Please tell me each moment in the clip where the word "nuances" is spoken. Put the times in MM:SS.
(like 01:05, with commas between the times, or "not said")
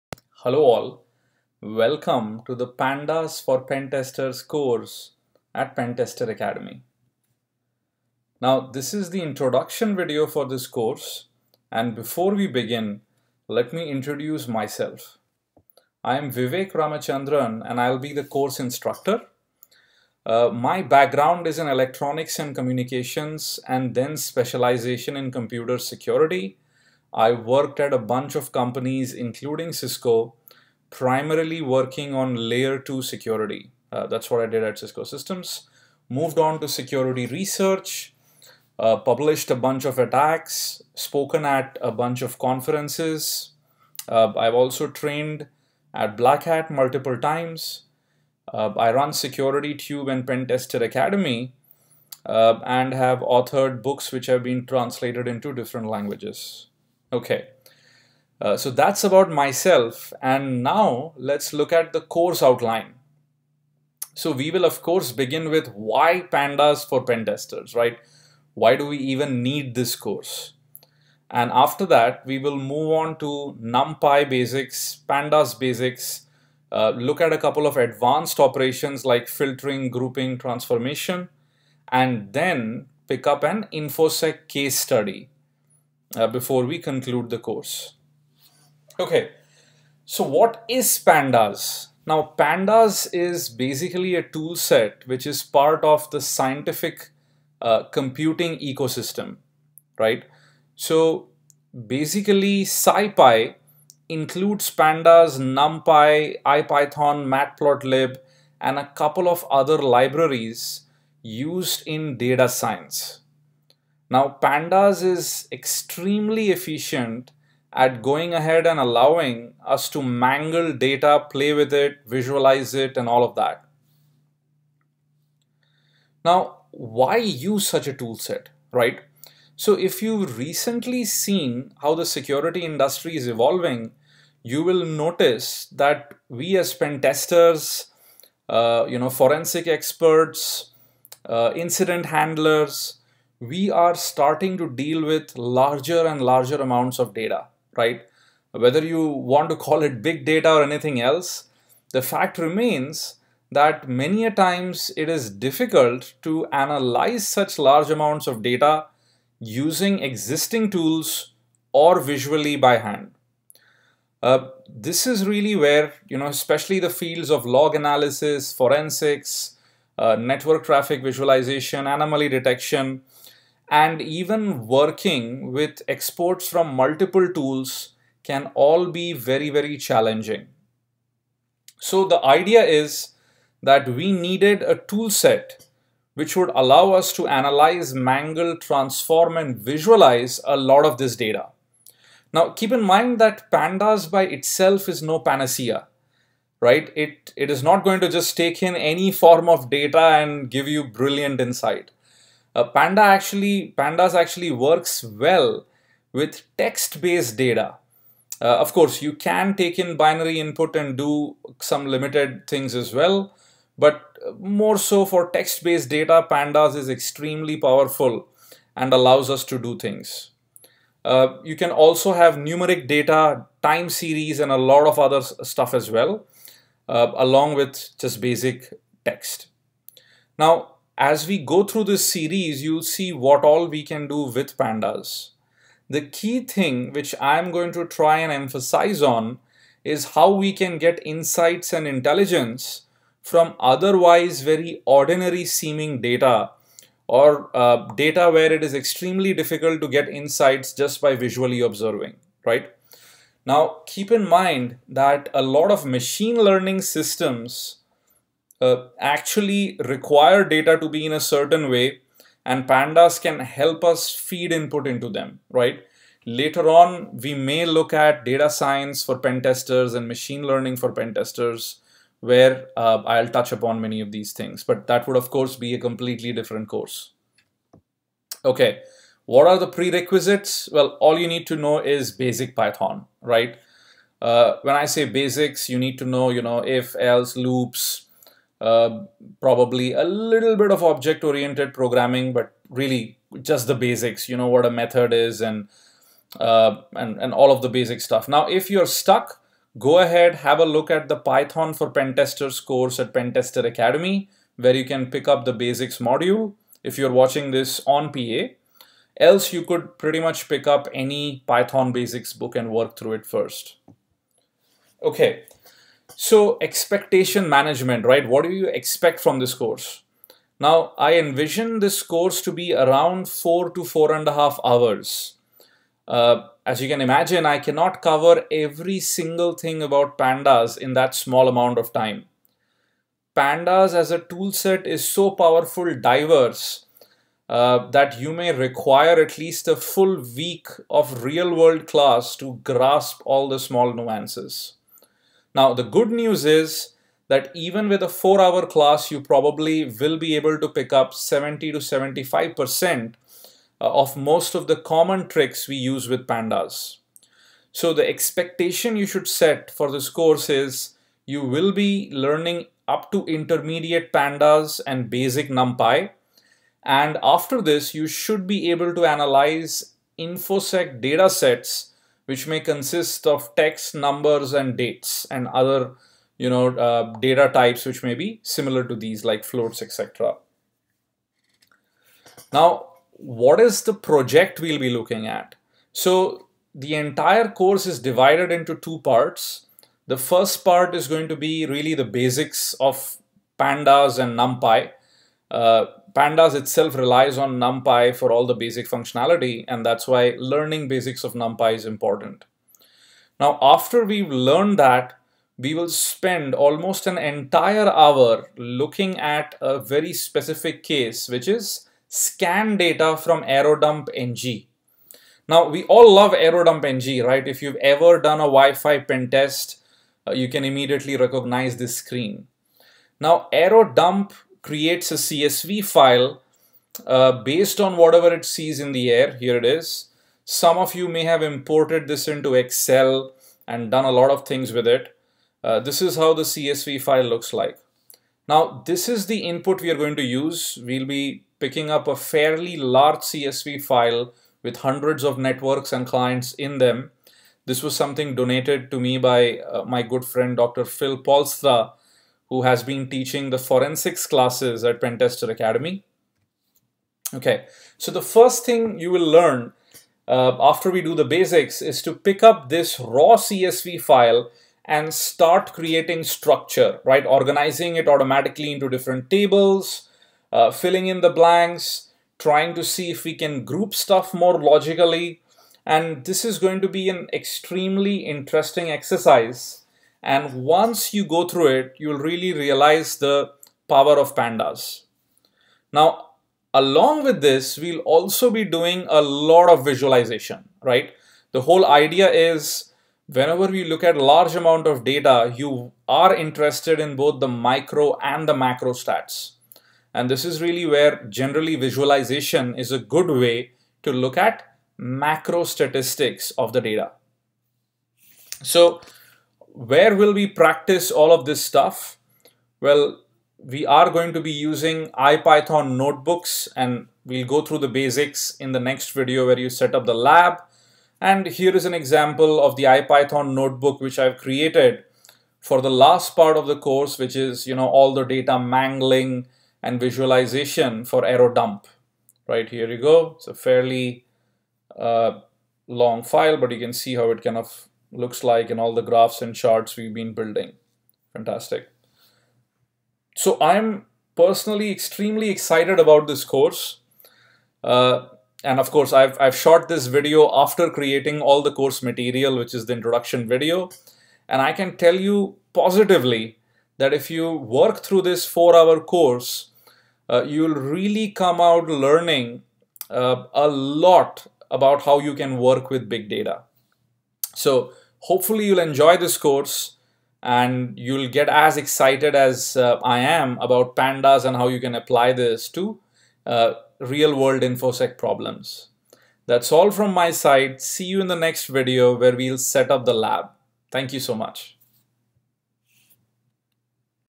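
05:43.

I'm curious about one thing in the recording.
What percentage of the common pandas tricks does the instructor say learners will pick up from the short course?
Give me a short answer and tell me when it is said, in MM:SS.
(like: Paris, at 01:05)
70 to 75%, at 05:51.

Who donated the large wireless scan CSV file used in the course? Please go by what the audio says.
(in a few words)
Dr. Phil Polstra.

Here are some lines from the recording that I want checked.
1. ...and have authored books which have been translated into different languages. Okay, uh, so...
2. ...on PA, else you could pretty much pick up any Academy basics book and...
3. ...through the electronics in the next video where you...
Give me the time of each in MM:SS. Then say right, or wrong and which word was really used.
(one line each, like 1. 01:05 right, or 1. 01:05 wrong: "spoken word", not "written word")
1. 00:52 right
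2. 05:07 wrong: "Python", not "Academy"
3. 08:37 wrong: "basics", not "electronics".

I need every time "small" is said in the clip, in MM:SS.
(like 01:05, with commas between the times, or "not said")
05:31, 05:43.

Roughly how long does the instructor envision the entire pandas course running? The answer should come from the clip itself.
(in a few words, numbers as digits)
4 to 4.5 hours.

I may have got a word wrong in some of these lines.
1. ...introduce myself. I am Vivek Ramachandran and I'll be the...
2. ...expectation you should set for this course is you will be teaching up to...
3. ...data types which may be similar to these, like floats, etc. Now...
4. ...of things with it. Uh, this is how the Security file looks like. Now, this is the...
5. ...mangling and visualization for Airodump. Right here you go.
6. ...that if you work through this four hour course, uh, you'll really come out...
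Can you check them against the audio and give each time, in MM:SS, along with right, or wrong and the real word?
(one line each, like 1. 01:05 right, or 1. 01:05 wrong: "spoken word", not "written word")
1. 00:13 right
2. 05:58 wrong: "learning", not "teaching"
3. 06:17 right
4. 07:14 wrong: "CSV", not "Security"
5. 08:48 right
6. 09:16 right.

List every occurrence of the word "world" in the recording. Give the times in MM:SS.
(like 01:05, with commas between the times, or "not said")
05:41, 09:37.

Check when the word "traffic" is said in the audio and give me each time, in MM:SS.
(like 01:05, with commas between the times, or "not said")
02:50.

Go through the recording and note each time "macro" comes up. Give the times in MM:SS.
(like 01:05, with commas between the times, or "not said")
08:18, 08:24.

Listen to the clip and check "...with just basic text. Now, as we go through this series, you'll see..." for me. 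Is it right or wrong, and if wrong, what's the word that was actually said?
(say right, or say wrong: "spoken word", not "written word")
right.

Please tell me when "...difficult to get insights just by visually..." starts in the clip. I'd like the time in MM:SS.
04:09.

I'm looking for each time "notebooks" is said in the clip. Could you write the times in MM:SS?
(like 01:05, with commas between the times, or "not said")
08:35, 08:43.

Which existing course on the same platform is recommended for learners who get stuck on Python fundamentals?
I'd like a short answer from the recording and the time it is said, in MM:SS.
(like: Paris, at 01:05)
Python for pentesters, at 05:01.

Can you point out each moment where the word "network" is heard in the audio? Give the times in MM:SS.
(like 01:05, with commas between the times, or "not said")
02:50, 07:25.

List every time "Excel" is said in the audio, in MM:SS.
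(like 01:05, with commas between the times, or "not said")
07:12.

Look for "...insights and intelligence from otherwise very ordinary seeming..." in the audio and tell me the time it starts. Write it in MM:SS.
04:01.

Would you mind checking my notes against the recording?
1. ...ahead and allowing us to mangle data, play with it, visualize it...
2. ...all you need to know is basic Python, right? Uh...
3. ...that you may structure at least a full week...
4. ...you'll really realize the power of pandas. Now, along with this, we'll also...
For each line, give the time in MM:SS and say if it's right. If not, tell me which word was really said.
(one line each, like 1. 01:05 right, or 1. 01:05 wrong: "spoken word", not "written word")
1. 01:58 right
2. 04:40 right
3. 05:37 wrong: "require", not "structure"
4. 08:01 right.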